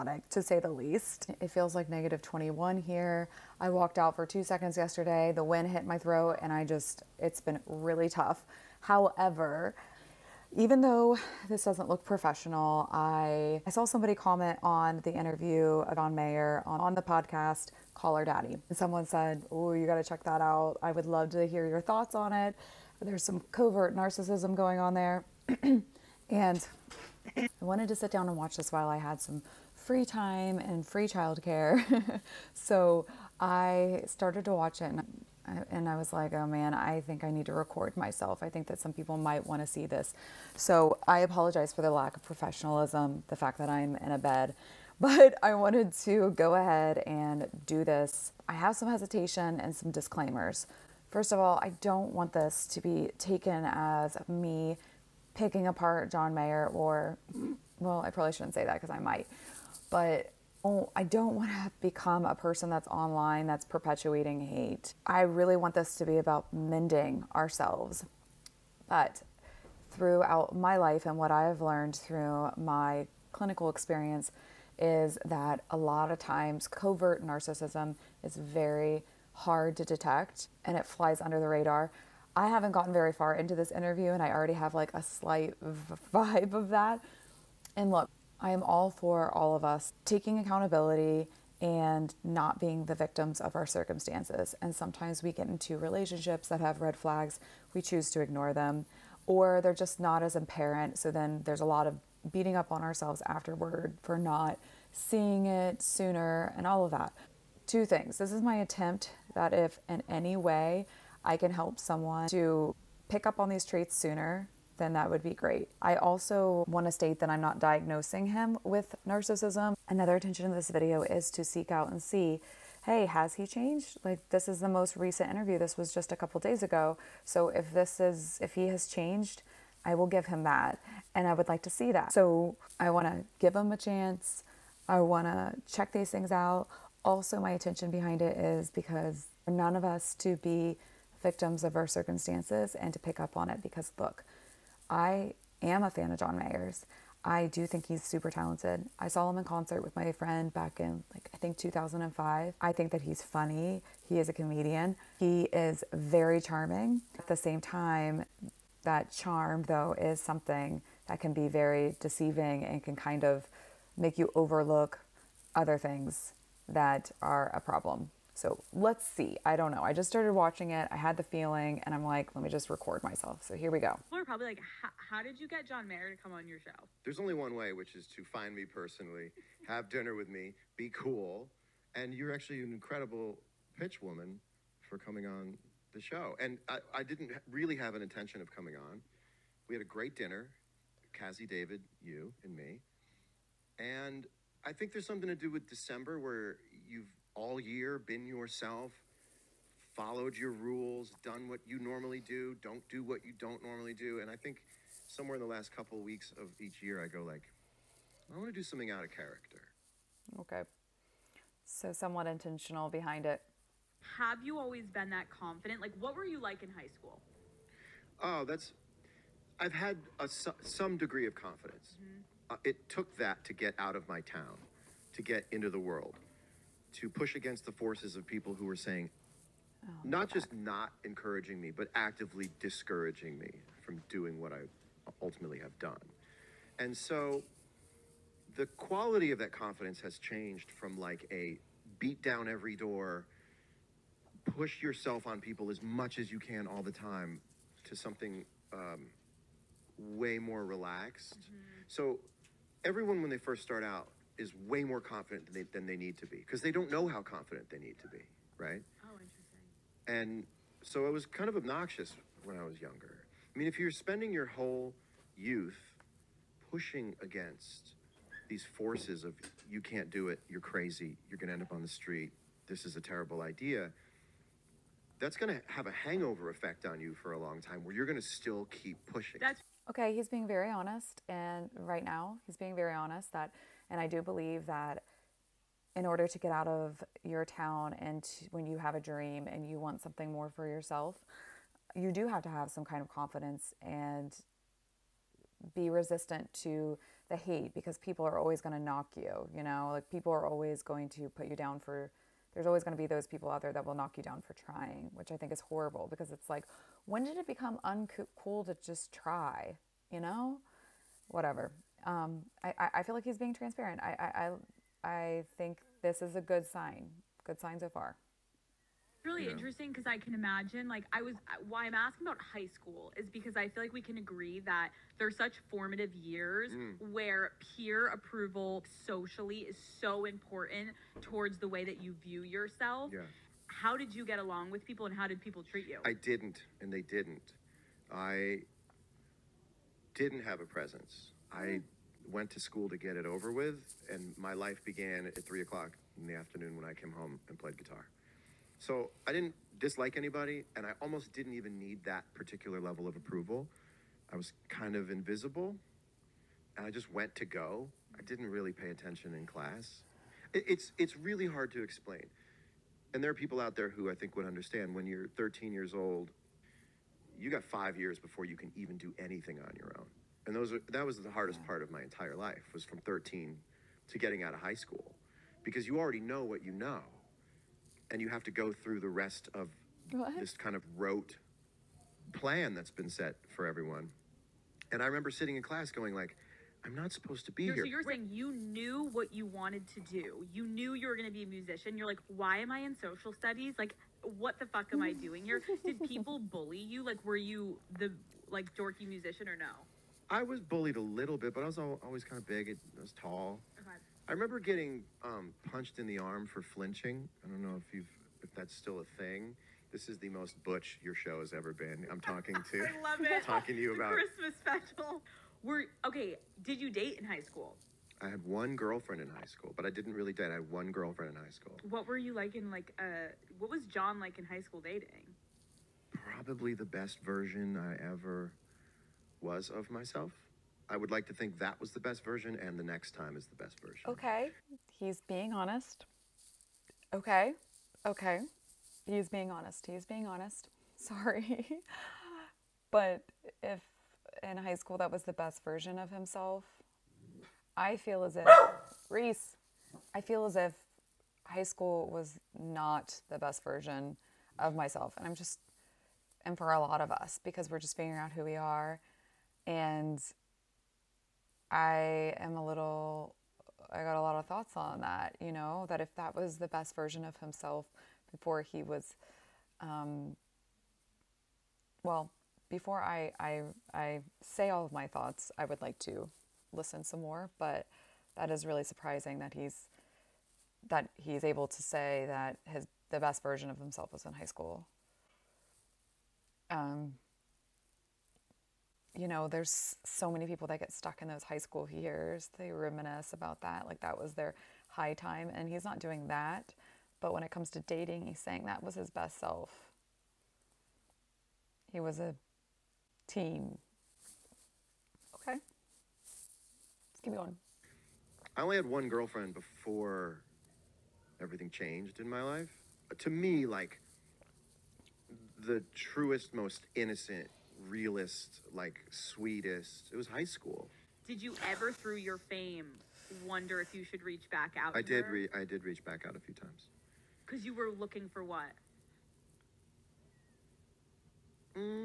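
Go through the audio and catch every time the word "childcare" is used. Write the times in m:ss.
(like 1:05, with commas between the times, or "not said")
0:31.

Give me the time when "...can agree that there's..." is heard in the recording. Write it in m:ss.
5:24.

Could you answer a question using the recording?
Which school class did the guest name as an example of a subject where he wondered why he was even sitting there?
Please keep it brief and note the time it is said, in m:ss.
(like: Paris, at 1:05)
Social studies, at 6:33.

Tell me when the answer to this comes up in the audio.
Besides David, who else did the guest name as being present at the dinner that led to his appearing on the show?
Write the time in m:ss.
3:11.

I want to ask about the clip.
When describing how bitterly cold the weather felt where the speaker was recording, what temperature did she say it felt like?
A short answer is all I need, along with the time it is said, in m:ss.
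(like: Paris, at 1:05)
-21, at 0:01.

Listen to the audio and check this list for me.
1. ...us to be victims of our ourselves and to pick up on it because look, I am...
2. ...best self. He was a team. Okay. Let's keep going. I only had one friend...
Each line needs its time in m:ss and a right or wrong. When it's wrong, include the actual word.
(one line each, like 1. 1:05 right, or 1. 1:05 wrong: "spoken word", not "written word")
1. 2:19 wrong: "circumstances", not "ourselves"
2. 8:19 wrong: "girlfriend", not "friend".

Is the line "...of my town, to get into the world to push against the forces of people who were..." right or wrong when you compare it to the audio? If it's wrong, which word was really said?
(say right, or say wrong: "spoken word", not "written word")
right.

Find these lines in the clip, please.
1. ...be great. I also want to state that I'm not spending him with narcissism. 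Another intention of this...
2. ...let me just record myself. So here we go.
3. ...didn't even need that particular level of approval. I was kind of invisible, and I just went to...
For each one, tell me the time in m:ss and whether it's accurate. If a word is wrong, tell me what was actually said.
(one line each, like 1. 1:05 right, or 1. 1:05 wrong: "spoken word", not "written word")
1. 1:55 wrong: "diagnosing", not "spending"
2. 2:52 right
3. 5:51 right.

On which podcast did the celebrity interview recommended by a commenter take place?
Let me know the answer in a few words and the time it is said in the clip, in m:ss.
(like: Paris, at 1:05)
Call Her Daddy, at 0:17.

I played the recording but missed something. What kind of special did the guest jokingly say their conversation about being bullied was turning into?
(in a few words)
Christmas special.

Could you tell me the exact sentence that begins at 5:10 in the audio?
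You know, whatever um, I, I feel like he's being transparent.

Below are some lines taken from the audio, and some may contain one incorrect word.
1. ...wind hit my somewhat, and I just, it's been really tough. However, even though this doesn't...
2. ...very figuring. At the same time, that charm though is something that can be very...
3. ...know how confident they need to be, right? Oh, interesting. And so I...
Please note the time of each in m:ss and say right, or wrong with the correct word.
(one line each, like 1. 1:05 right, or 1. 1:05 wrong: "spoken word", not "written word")
1. 0:05 wrong: "throat", not "somewhat"
2. 2:35 wrong: "charming", not "figuring"
3. 4:16 right.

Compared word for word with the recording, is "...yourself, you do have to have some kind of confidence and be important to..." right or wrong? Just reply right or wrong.
wrong.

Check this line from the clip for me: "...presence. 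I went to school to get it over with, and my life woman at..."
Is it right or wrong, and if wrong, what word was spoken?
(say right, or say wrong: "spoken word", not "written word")
wrong: "began", not "woman".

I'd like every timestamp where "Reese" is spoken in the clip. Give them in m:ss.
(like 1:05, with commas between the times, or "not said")
7:29.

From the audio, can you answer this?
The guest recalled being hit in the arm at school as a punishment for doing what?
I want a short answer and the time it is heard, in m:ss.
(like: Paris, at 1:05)
Flinching, at 6:46.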